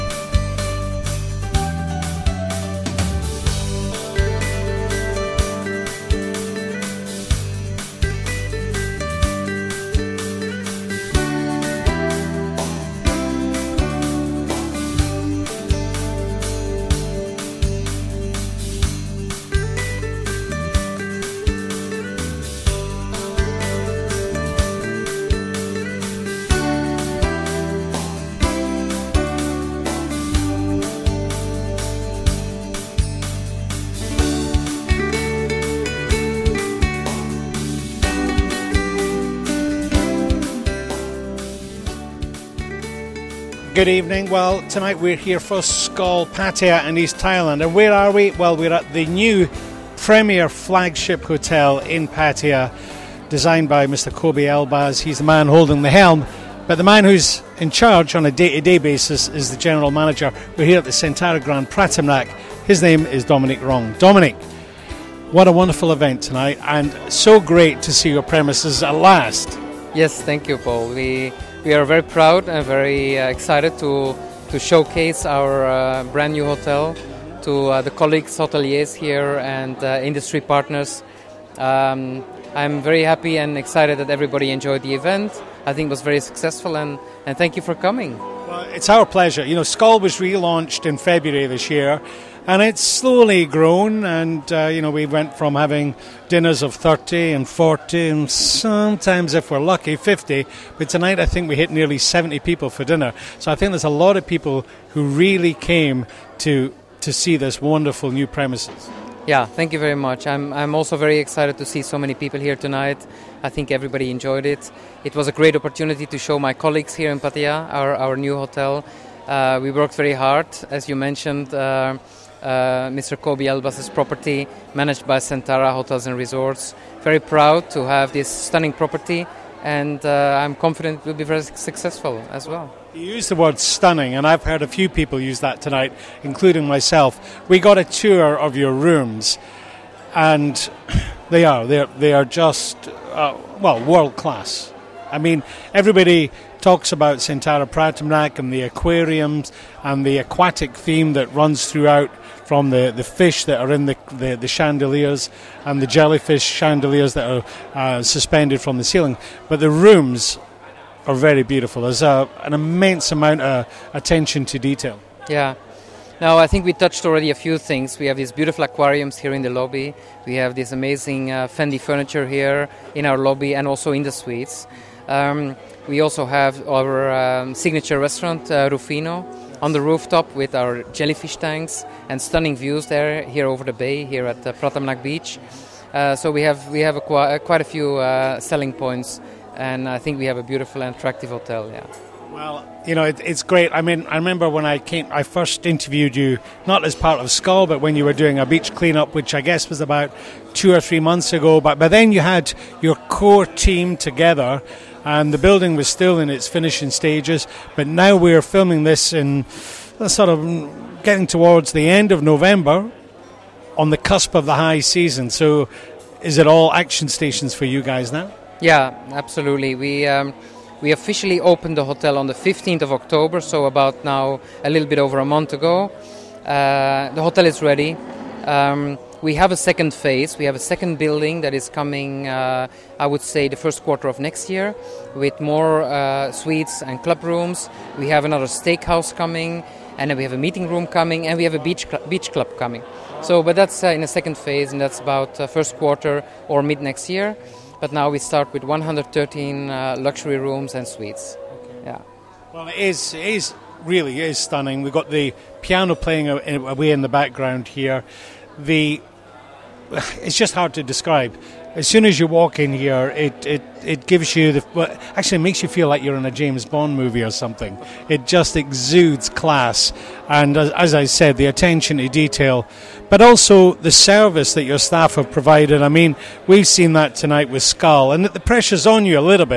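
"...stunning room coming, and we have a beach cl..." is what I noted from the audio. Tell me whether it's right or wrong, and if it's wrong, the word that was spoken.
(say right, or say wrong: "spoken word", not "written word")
wrong: "meeting", not "stunning".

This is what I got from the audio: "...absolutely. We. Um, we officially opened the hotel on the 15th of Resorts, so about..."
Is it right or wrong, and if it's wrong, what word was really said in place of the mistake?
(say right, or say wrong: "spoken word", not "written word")
wrong: "October", not "Resorts".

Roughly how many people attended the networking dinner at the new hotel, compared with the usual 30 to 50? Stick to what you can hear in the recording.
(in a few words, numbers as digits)
nearly 70.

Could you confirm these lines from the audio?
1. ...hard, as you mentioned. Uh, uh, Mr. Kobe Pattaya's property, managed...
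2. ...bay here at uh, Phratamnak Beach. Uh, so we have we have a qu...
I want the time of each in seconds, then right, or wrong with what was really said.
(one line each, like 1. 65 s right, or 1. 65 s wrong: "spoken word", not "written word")
1. 120 s wrong: "Elbas", not "Pattaya"
2. 183 s right.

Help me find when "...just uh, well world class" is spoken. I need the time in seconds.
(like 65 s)
142 s.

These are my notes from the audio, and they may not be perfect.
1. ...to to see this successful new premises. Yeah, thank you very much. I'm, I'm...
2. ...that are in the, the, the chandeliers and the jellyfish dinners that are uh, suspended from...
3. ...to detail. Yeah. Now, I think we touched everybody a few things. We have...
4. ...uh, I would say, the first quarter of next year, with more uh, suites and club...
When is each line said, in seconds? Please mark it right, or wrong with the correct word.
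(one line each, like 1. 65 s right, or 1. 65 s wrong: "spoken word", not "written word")
1. 106 s wrong: "wonderful", not "successful"
2. 153 s wrong: "chandeliers", not "dinners"
3. 164 s wrong: "already", not "everybody"
4. 232 s right.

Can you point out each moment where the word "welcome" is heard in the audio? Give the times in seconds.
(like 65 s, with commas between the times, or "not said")
not said.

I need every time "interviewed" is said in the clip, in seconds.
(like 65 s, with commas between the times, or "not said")
195 s.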